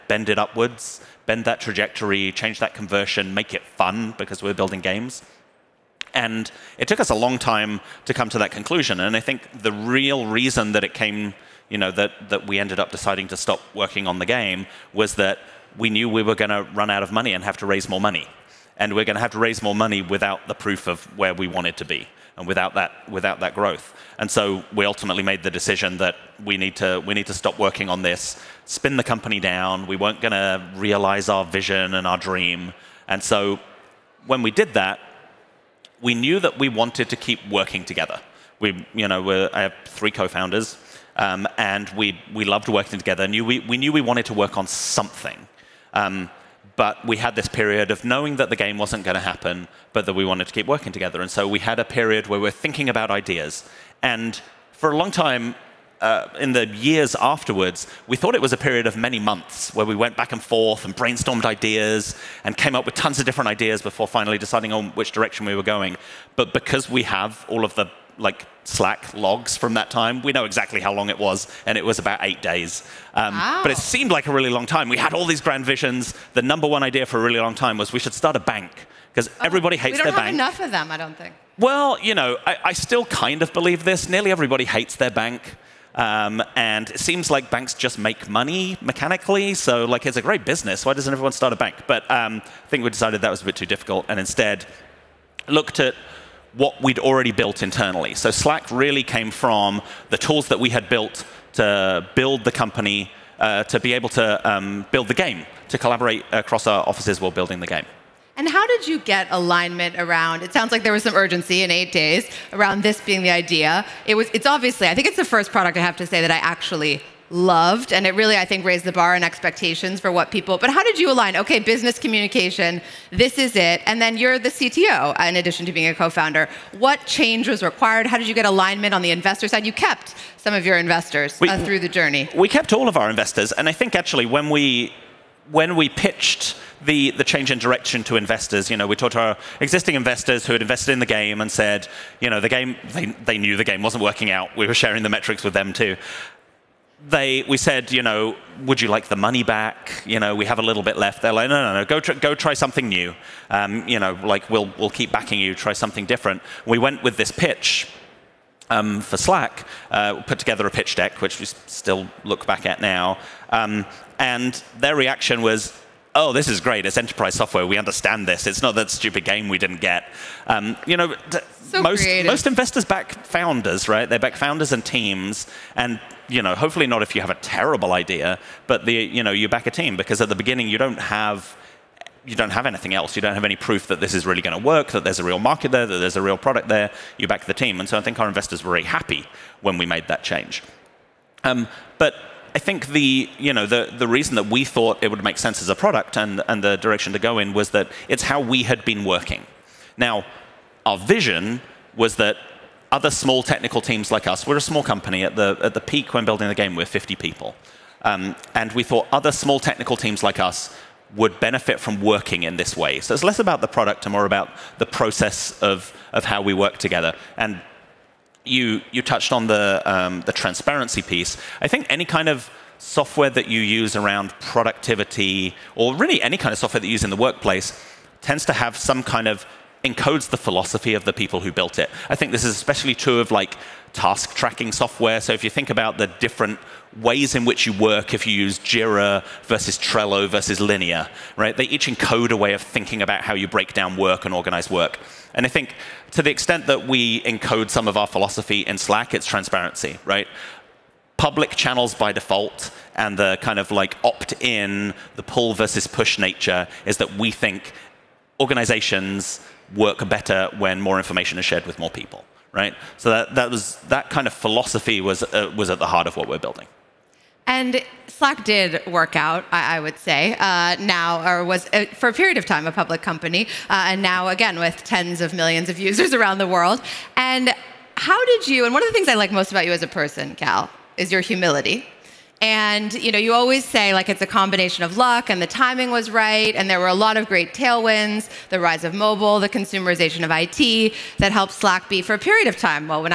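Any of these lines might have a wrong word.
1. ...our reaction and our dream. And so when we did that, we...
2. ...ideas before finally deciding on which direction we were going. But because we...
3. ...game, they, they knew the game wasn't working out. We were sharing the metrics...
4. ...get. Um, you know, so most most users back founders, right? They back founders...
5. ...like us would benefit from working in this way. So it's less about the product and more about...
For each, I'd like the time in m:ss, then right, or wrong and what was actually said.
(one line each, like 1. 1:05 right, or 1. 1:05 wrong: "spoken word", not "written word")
1. 0:31 wrong: "vision", not "reaction"
2. 1:03 right
3. 2:22 right
4. 2:49 wrong: "investors", not "users"
5. 3:30 right.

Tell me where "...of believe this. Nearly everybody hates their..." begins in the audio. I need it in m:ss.
1:23.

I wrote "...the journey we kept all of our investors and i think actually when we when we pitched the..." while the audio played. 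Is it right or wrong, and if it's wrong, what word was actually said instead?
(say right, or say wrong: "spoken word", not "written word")
right.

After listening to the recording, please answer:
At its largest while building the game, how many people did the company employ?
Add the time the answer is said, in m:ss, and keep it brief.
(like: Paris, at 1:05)
50, at 3:26.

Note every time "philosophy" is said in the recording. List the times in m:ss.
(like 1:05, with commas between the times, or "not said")
3:50, 4:08, 4:24.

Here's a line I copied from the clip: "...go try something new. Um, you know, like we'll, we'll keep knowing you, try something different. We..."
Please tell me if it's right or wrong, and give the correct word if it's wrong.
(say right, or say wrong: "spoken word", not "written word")
wrong: "backing", not "knowing".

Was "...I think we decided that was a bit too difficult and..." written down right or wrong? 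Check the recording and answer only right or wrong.
right.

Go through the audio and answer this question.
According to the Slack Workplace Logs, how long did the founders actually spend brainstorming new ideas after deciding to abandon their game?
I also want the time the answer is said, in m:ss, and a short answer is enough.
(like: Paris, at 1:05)
About 8 days, at 1:11.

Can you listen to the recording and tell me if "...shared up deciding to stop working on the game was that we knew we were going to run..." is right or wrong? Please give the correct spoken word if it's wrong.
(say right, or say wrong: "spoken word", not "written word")
wrong: "ended", not "shared".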